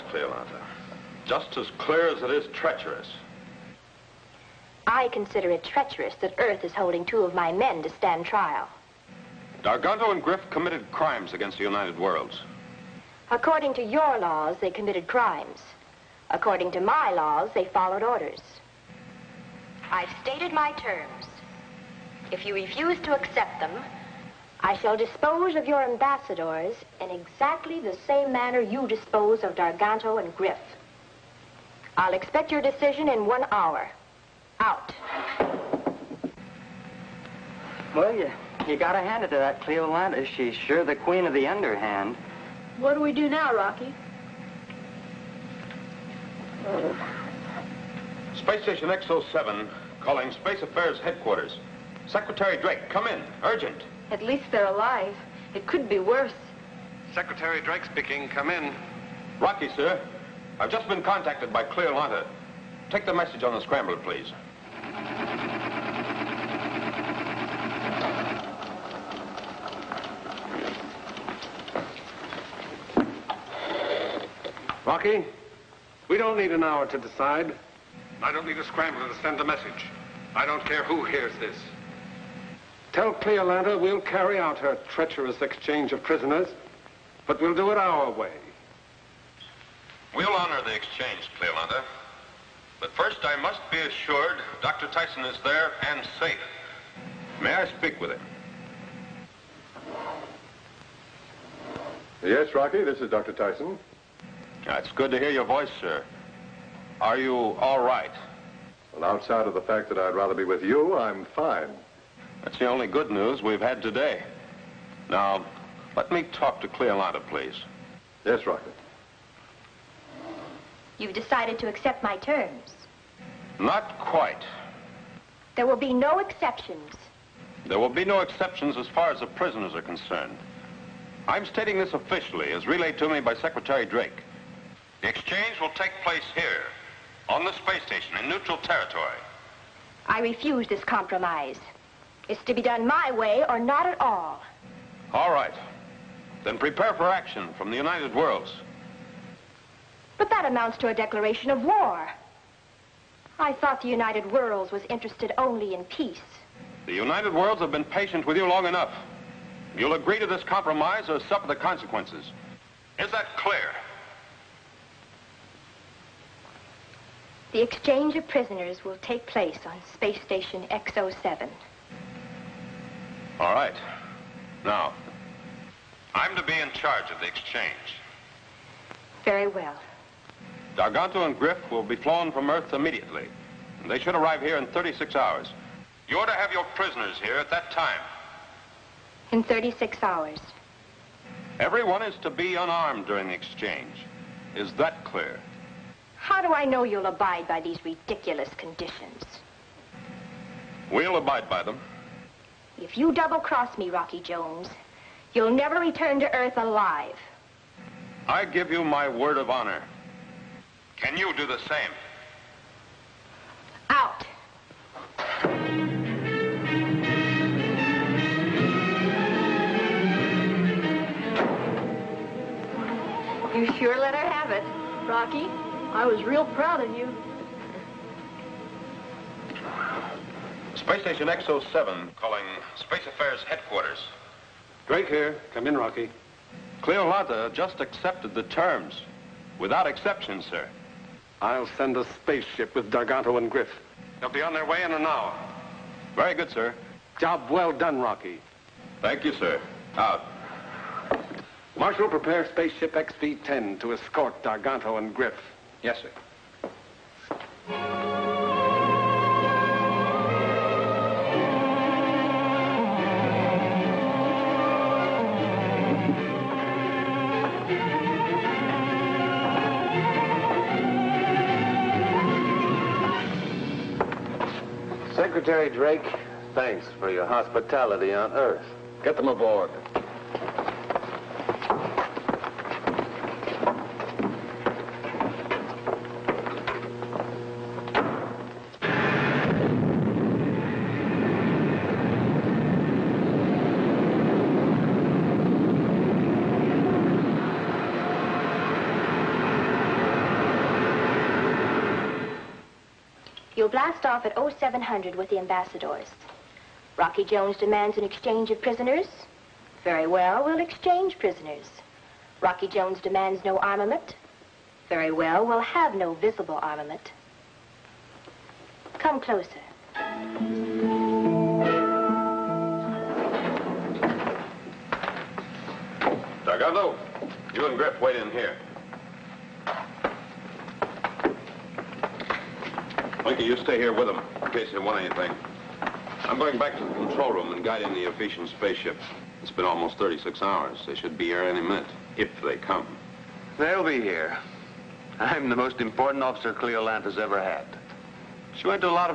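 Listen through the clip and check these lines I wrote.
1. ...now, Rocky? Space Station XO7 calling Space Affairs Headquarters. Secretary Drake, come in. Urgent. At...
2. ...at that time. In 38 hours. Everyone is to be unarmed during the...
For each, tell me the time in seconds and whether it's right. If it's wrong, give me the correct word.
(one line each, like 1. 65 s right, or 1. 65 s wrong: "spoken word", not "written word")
1. 43 s right
2. 187 s wrong: "36", not "38".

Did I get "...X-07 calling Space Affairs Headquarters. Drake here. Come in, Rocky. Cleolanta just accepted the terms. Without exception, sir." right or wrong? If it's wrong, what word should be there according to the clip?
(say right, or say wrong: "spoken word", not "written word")
right.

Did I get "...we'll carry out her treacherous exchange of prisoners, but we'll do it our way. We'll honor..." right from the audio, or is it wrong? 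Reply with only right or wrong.
right.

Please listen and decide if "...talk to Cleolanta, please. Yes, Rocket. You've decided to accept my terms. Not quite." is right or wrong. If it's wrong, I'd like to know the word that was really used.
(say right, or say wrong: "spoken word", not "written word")
right.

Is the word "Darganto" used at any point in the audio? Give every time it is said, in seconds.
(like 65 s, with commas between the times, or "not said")
9 s, 29 s, 180 s, 242 s, 254 s, 326 s.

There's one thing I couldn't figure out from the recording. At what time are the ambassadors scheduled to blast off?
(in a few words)
0700.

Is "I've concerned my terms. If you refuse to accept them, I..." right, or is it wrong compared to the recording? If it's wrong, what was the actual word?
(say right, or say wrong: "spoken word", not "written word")
wrong: "stated", not "concerned".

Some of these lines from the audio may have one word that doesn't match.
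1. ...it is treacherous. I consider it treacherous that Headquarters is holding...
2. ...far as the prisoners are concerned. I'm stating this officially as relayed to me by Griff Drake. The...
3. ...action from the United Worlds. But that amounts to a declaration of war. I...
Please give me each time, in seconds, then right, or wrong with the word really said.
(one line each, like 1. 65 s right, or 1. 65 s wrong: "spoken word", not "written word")
1. 2 s wrong: "Earth", not "Headquarters"
2. 128 s wrong: "Secretary", not "Griff"
3. 147 s right.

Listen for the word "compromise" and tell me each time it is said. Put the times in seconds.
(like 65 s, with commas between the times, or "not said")
140 s, 160 s.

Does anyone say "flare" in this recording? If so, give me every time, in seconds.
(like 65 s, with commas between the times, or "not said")
not said.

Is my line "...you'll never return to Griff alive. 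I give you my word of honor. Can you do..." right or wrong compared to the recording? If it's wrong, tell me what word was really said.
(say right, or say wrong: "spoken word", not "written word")
wrong: "Earth", not "Griff".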